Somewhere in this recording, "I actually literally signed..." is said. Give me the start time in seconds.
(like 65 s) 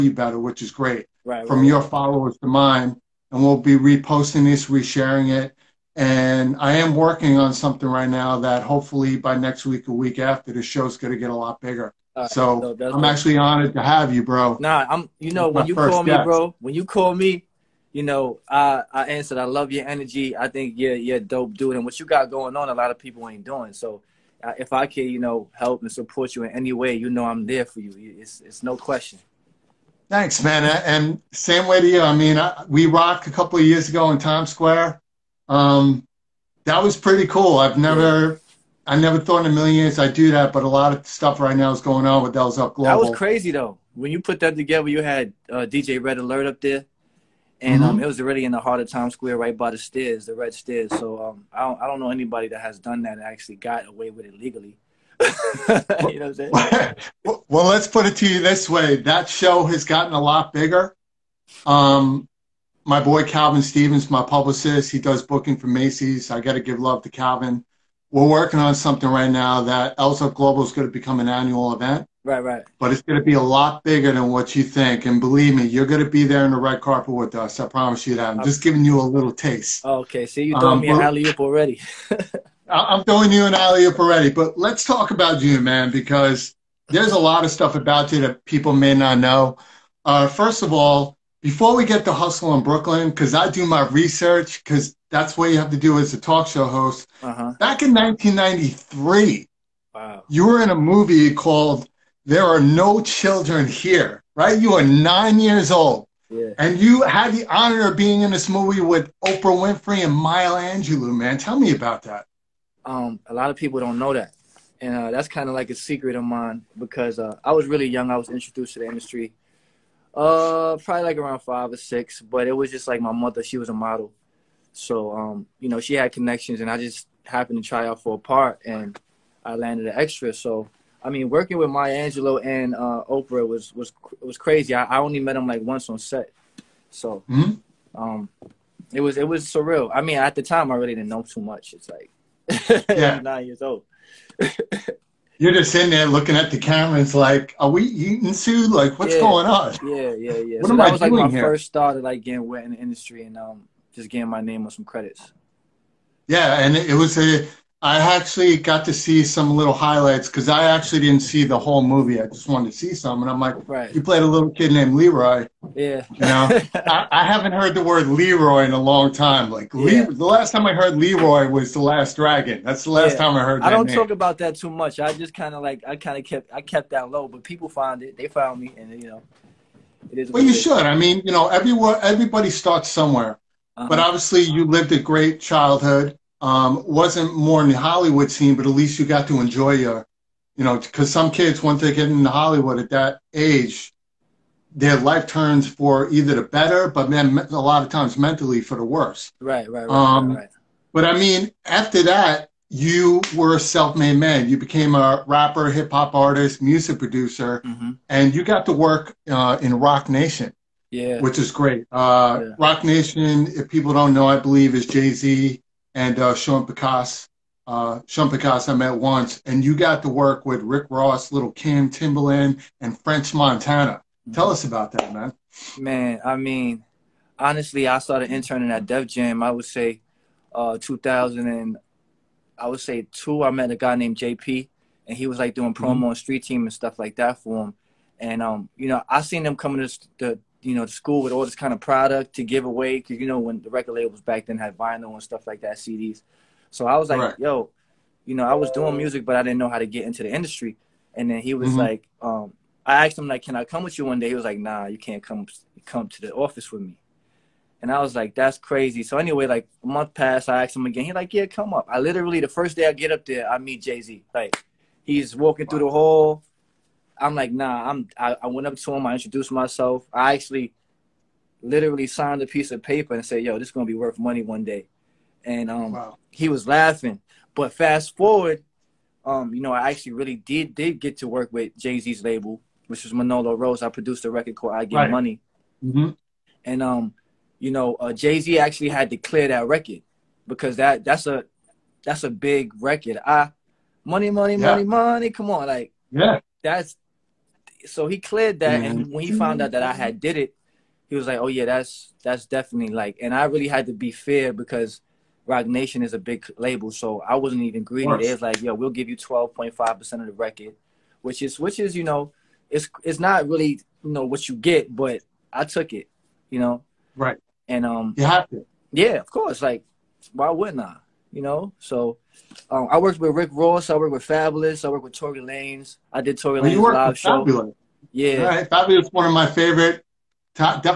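270 s.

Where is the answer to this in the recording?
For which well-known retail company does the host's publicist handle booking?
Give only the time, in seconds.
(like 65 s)
65 s.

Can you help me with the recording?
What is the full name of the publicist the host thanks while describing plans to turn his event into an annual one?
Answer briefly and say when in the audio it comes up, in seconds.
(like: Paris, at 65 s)
Calvin Stevens, at 63 s.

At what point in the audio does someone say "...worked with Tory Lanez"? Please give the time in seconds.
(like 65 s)
324 s.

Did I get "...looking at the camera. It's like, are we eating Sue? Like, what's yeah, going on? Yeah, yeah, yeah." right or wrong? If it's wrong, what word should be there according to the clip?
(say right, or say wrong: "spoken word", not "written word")
right.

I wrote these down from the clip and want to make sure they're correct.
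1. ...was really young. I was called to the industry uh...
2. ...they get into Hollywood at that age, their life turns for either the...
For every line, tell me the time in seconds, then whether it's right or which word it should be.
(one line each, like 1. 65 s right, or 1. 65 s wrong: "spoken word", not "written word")
1. 117 s wrong: "introduced", not "called"
2. 191 s right.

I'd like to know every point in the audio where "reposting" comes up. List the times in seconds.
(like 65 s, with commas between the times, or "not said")
3 s.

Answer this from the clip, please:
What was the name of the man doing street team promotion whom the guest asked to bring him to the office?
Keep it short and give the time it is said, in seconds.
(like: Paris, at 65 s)
JP, at 234 s.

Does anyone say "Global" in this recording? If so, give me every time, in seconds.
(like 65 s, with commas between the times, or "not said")
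42 s, 70 s.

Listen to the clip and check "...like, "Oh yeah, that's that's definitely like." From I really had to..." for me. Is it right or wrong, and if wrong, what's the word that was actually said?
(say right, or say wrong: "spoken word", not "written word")
wrong: "And", not "From".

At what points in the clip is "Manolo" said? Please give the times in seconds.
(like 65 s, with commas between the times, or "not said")
283 s.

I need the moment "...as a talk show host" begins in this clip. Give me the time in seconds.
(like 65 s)
95 s.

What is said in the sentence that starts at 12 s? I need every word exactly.
Right, so, so I'm actually honored to have you, bro.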